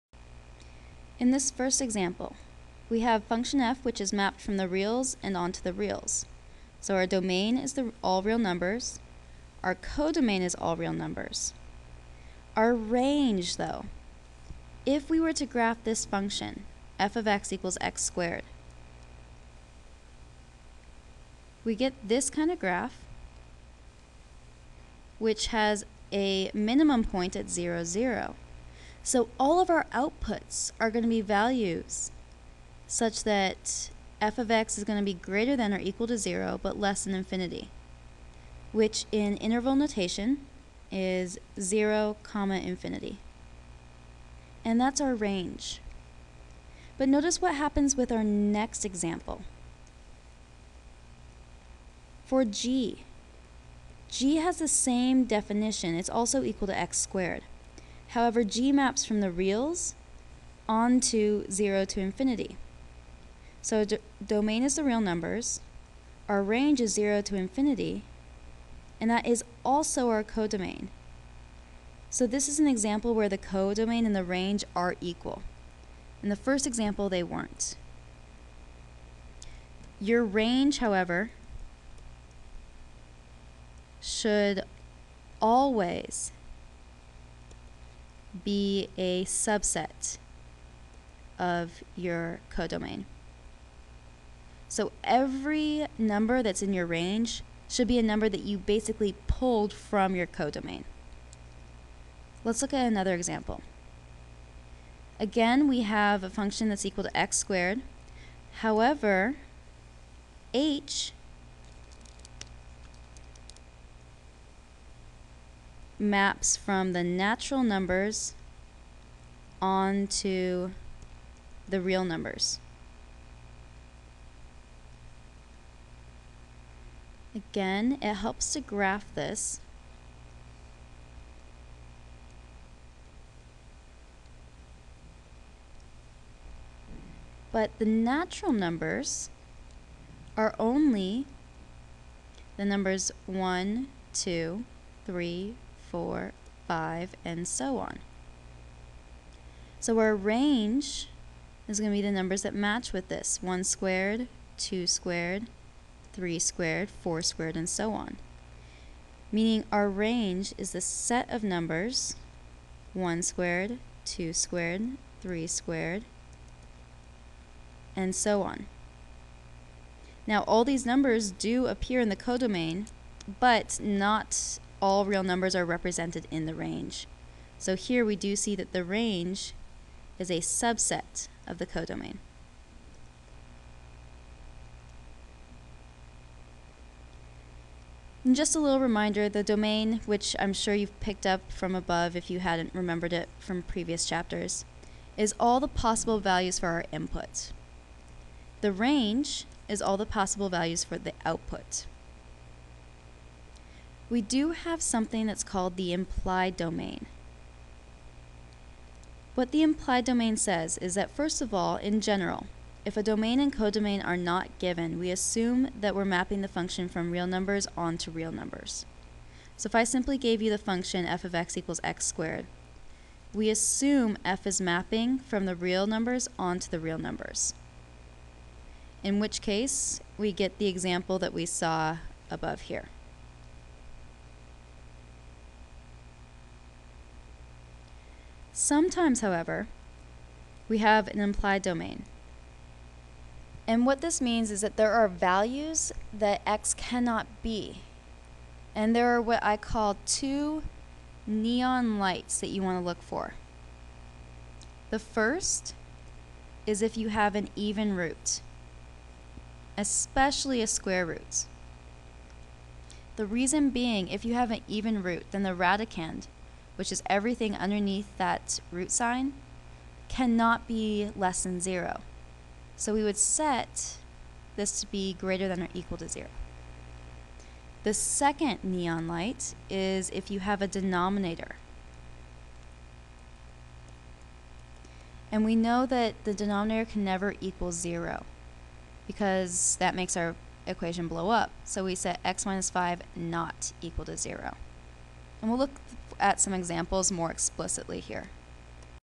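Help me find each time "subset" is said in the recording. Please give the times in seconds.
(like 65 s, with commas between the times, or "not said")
89 s, 180 s.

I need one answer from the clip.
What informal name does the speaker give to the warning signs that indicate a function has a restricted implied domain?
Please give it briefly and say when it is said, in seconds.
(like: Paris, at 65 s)
neon lights, at 251 s.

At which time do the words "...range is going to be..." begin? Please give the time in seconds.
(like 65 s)
150 s.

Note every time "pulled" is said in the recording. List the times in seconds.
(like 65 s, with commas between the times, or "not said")
99 s.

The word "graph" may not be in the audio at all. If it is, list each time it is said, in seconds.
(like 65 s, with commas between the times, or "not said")
15 s, 22 s, 128 s.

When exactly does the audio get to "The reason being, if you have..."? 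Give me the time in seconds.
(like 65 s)
263 s.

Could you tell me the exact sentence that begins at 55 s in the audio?
It's also equal to x squared.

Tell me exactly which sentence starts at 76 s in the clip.
In the first example, they weren't.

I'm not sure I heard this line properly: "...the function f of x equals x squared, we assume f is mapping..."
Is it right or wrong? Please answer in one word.
right.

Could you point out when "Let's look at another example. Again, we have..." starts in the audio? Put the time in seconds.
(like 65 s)
102 s.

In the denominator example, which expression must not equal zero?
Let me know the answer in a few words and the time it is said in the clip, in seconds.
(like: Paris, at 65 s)
x - 5, at 292 s.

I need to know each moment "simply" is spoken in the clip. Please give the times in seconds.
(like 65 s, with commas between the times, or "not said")
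219 s.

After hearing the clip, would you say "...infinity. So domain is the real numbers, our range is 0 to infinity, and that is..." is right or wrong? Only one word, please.
right.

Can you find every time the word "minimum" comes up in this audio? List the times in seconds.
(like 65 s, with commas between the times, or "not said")
26 s.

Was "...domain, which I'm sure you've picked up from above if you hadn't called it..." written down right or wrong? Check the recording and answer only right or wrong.
wrong.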